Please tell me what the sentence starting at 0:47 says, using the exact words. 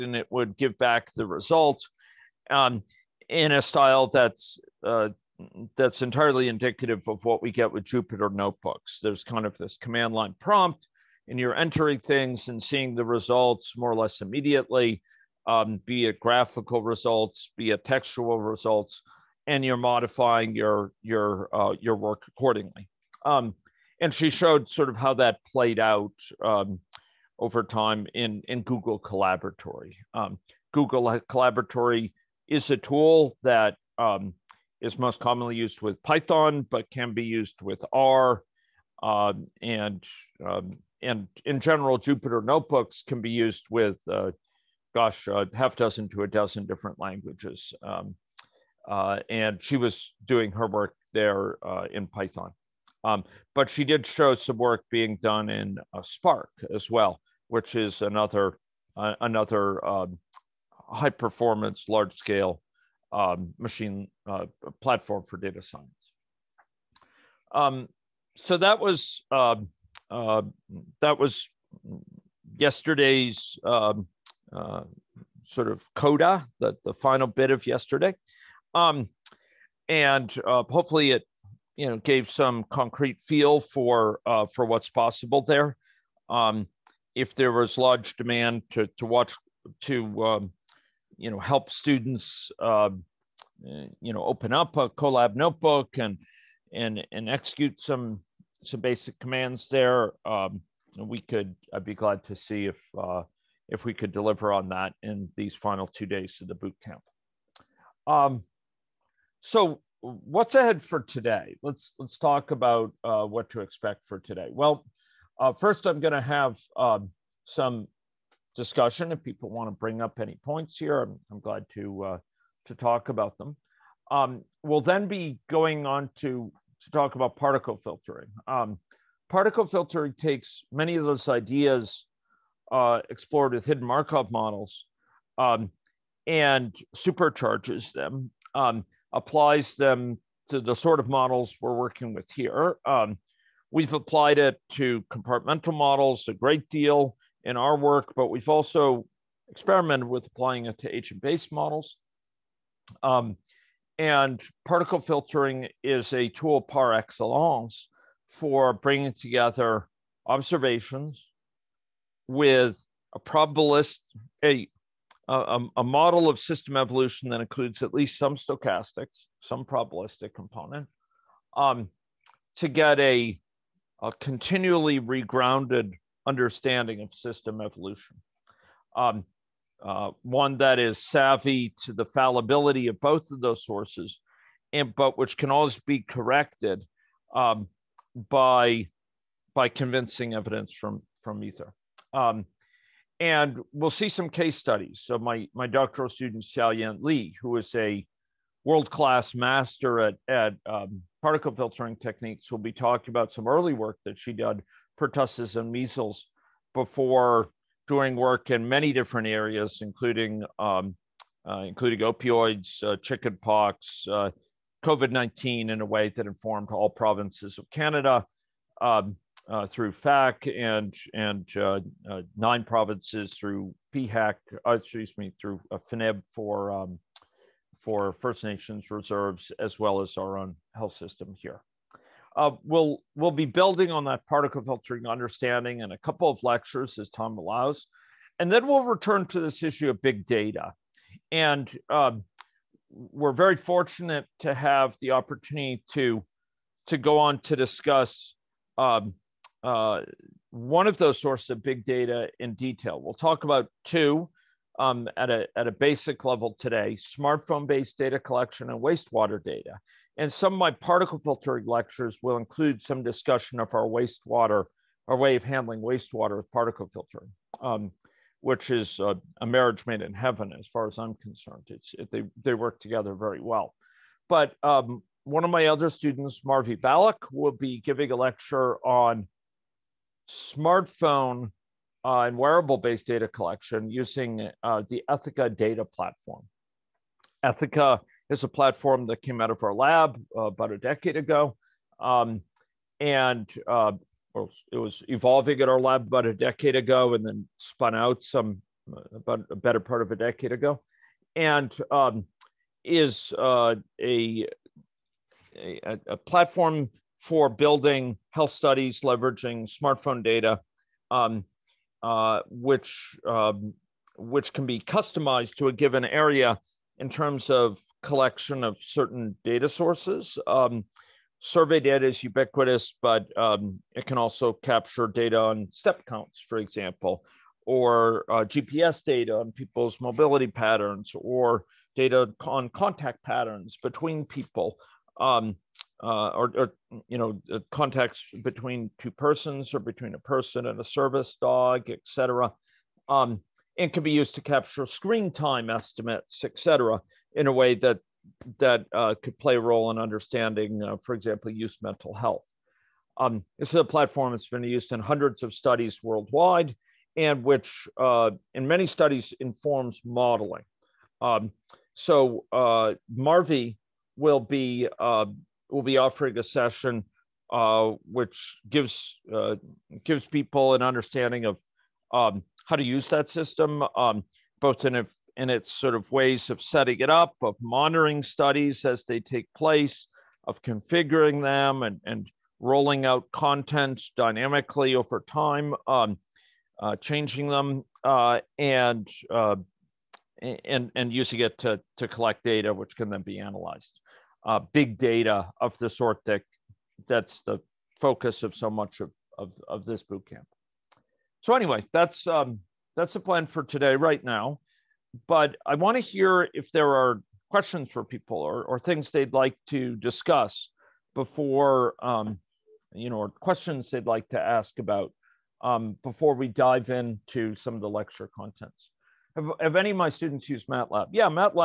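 Um, uh, and she was doing her work there uh, in Python.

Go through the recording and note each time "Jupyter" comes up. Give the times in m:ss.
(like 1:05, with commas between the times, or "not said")
0:07, 0:41.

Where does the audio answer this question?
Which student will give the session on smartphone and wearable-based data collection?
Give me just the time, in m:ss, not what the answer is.
4:36.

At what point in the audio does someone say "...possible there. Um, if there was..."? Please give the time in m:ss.
1:24.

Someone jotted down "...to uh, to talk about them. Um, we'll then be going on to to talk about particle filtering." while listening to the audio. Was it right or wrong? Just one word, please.
right.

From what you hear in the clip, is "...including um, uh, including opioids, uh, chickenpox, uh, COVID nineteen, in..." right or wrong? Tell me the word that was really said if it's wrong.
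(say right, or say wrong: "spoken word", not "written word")
right.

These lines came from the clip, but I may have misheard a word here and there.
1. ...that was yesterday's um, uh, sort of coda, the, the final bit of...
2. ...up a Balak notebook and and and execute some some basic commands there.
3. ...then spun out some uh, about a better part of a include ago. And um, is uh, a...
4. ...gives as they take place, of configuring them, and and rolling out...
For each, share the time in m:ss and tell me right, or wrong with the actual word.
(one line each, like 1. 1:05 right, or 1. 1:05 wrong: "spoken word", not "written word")
1. 1:11 right
2. 1:34 wrong: "Colab", not "Balak"
3. 4:57 wrong: "decade", not "include"
4. 6:18 wrong: "studies", not "gives".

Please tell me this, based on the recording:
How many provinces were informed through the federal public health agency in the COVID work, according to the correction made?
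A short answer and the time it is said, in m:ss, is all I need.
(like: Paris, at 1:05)
9, at 3:42.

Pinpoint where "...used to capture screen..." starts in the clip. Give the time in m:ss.
5:44.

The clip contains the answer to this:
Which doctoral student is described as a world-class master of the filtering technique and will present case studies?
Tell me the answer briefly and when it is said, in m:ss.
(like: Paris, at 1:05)
Xiaoyan Li, at 3:16.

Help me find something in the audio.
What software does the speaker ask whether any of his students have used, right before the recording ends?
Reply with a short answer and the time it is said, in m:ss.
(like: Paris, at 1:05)
MATLAB, at 7:00.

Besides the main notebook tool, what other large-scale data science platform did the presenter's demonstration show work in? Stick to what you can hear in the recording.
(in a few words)
Spark.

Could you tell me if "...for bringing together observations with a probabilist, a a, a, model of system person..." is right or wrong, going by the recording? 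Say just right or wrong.
wrong.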